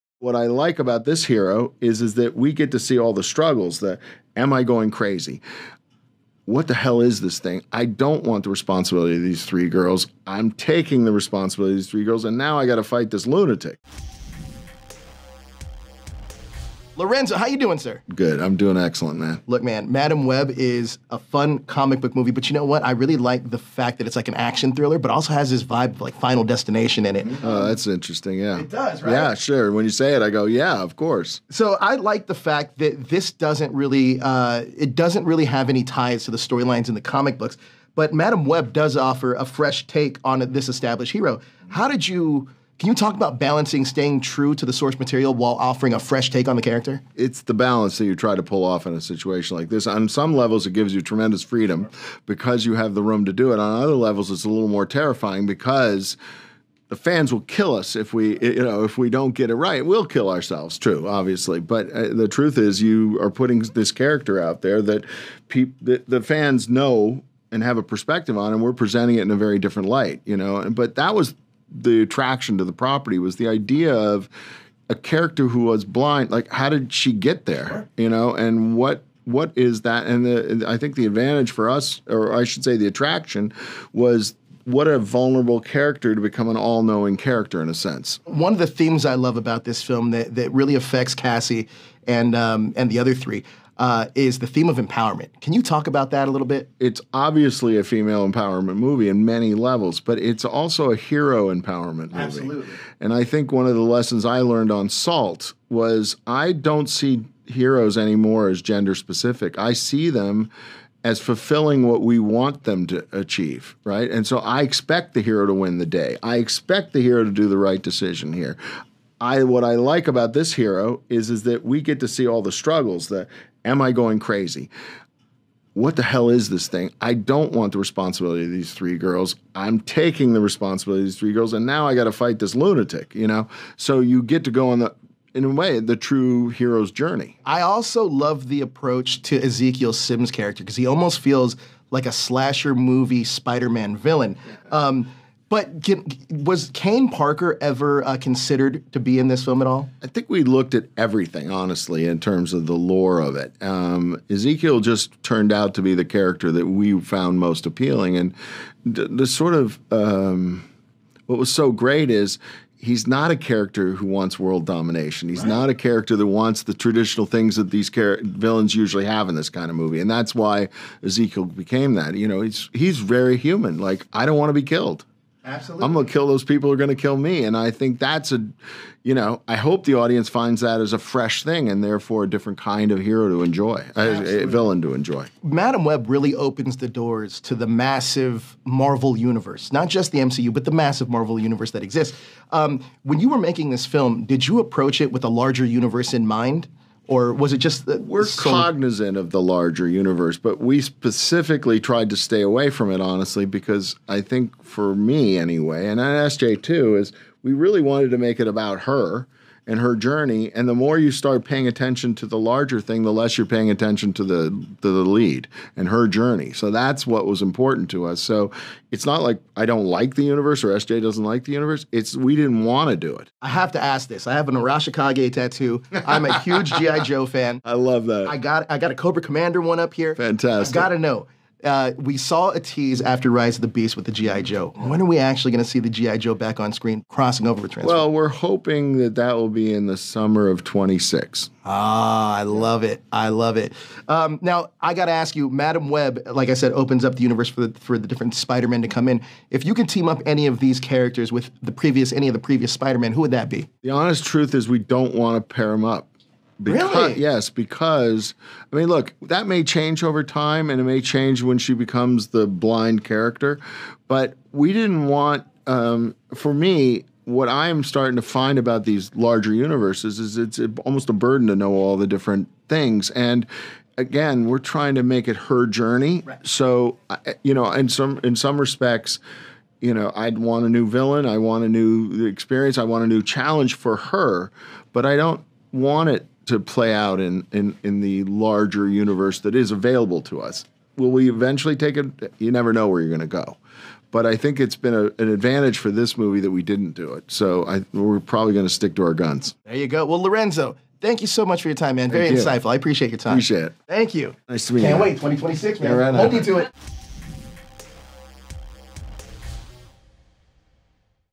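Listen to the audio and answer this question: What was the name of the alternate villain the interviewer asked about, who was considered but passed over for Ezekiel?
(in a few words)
Kaine Parker.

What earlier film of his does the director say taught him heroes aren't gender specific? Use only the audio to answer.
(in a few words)
Salt.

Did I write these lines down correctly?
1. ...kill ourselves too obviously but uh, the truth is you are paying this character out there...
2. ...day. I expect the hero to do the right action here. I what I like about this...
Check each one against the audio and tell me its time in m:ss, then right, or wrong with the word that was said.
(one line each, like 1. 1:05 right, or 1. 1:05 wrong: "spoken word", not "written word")
1. 1:00 wrong: "putting", not "paying"
2. 1:55 wrong: "decision", not "action".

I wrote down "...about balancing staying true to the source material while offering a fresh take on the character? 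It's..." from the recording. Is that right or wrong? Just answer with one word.
right.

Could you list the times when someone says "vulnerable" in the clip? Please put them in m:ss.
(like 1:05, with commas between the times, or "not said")
1:24.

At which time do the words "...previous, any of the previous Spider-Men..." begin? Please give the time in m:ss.
4:11.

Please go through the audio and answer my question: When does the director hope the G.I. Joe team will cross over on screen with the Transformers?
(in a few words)
summer of 2026.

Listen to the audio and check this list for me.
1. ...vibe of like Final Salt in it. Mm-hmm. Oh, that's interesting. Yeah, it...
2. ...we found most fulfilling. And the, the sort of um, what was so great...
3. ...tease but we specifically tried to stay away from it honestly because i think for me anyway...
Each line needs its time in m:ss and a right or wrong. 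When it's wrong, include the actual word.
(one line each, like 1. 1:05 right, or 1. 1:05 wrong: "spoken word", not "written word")
1. 0:25 wrong: "Destination", not "Salt"
2. 2:36 wrong: "appealing", not "fulfilling"
3. 3:19 wrong: "universe", not "tease".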